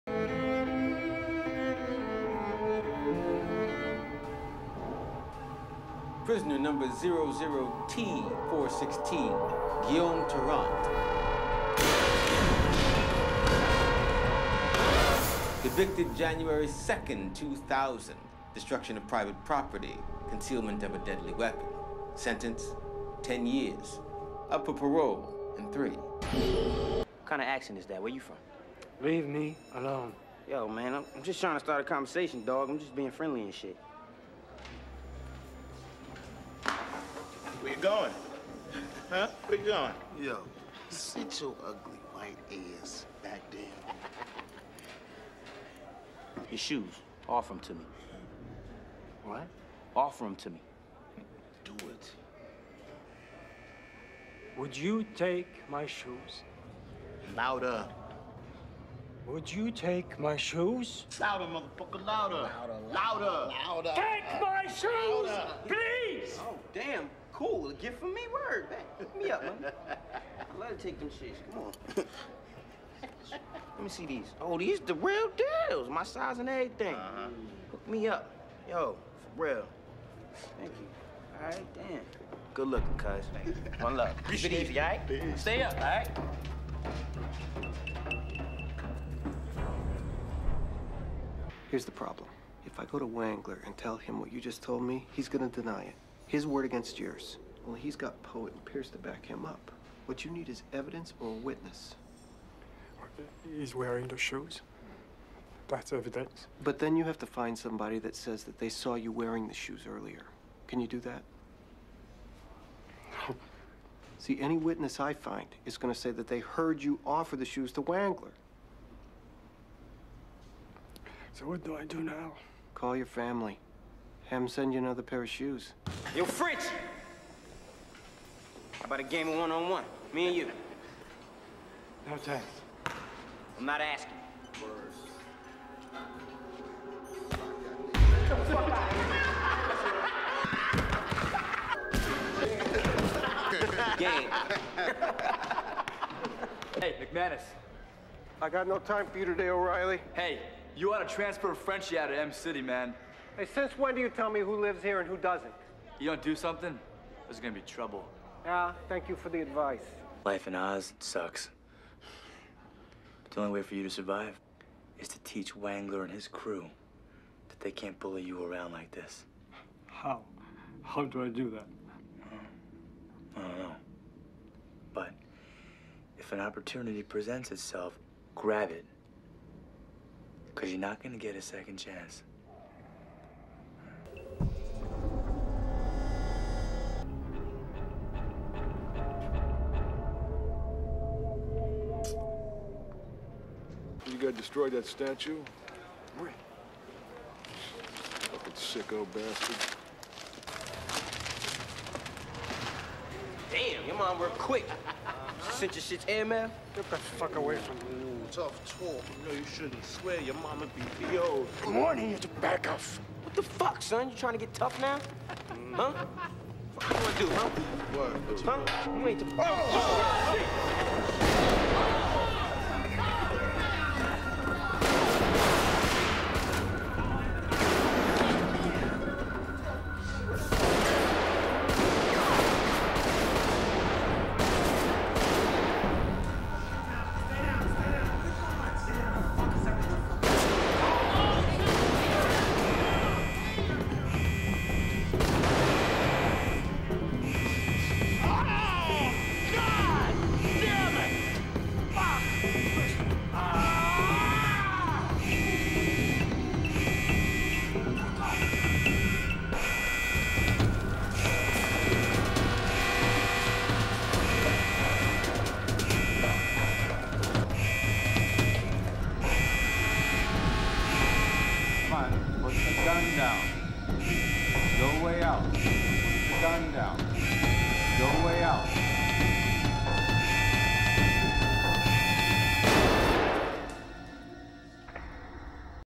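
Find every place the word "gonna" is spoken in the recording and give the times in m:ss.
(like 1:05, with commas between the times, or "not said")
1:35, 2:37.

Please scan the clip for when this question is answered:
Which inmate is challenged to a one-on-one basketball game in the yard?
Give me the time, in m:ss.
2:06.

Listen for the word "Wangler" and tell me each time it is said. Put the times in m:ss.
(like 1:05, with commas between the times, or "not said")
1:33, 1:57, 2:45.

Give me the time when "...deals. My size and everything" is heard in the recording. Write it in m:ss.
1:15.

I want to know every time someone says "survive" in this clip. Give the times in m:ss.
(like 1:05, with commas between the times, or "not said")
2:43.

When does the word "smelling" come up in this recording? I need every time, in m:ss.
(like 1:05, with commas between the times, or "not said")
not said.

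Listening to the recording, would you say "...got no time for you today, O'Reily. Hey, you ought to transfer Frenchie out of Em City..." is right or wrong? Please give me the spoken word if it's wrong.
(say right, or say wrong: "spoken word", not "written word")
right.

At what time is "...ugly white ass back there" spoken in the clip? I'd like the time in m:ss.
0:41.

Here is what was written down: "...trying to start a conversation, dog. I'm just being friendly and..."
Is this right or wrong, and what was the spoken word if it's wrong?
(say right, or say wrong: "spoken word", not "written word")
right.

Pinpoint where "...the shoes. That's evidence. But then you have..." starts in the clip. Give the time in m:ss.
1:44.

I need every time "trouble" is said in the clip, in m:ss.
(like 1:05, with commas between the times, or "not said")
2:37.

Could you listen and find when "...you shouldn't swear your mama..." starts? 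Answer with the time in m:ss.
3:29.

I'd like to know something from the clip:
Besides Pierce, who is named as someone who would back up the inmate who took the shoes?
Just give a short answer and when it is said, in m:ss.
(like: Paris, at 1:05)
Poet, at 1:38.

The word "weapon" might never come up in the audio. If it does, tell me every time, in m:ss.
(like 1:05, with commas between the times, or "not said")
0:21.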